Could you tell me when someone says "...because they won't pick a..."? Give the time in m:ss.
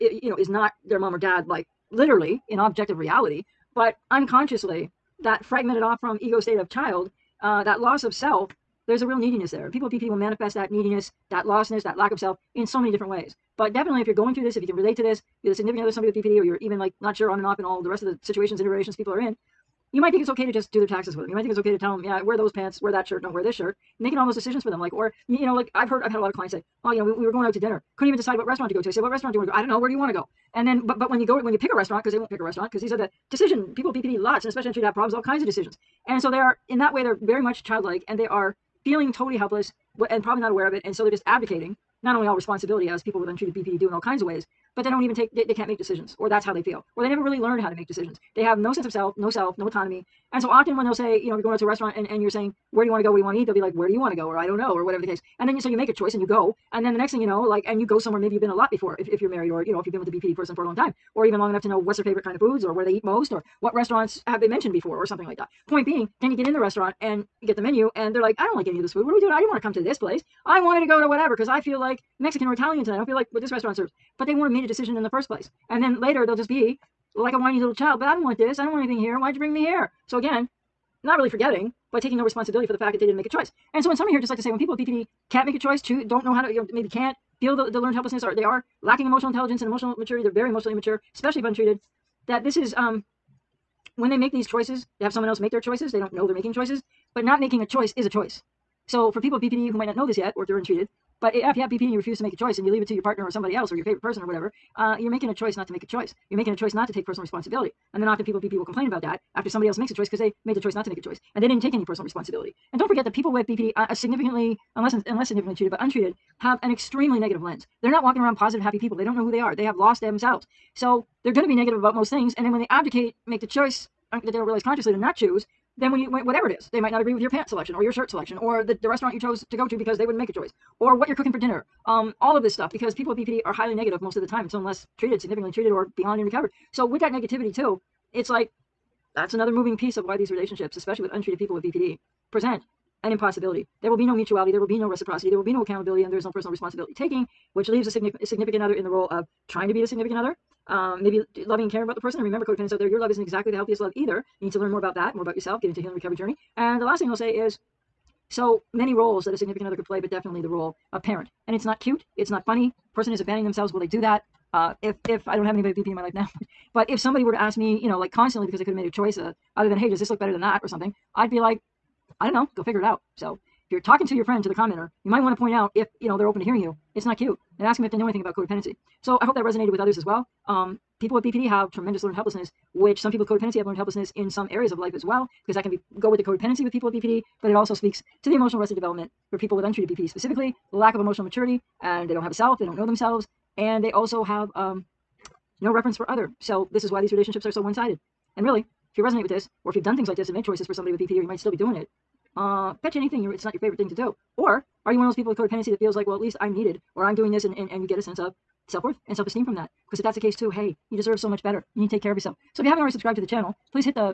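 0:32.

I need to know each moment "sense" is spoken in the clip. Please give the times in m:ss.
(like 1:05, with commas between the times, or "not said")
0:48, 3:28.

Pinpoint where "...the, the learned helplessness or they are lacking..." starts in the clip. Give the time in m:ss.
1:27.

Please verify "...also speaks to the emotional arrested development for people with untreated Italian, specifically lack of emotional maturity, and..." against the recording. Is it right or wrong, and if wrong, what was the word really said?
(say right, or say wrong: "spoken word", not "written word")
wrong: "BPD", not "Italian".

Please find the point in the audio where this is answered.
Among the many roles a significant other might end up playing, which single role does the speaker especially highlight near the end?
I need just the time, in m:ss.
2:41.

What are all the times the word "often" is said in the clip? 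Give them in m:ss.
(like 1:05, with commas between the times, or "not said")
0:50, 1:48.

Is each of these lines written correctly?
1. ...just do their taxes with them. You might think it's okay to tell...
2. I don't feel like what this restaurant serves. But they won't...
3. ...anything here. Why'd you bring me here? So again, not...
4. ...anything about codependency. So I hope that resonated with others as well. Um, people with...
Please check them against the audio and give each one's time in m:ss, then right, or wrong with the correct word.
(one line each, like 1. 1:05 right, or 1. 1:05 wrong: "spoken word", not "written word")
1. 0:20 right
2. 1:12 right
3. 1:18 right
4. 2:58 right.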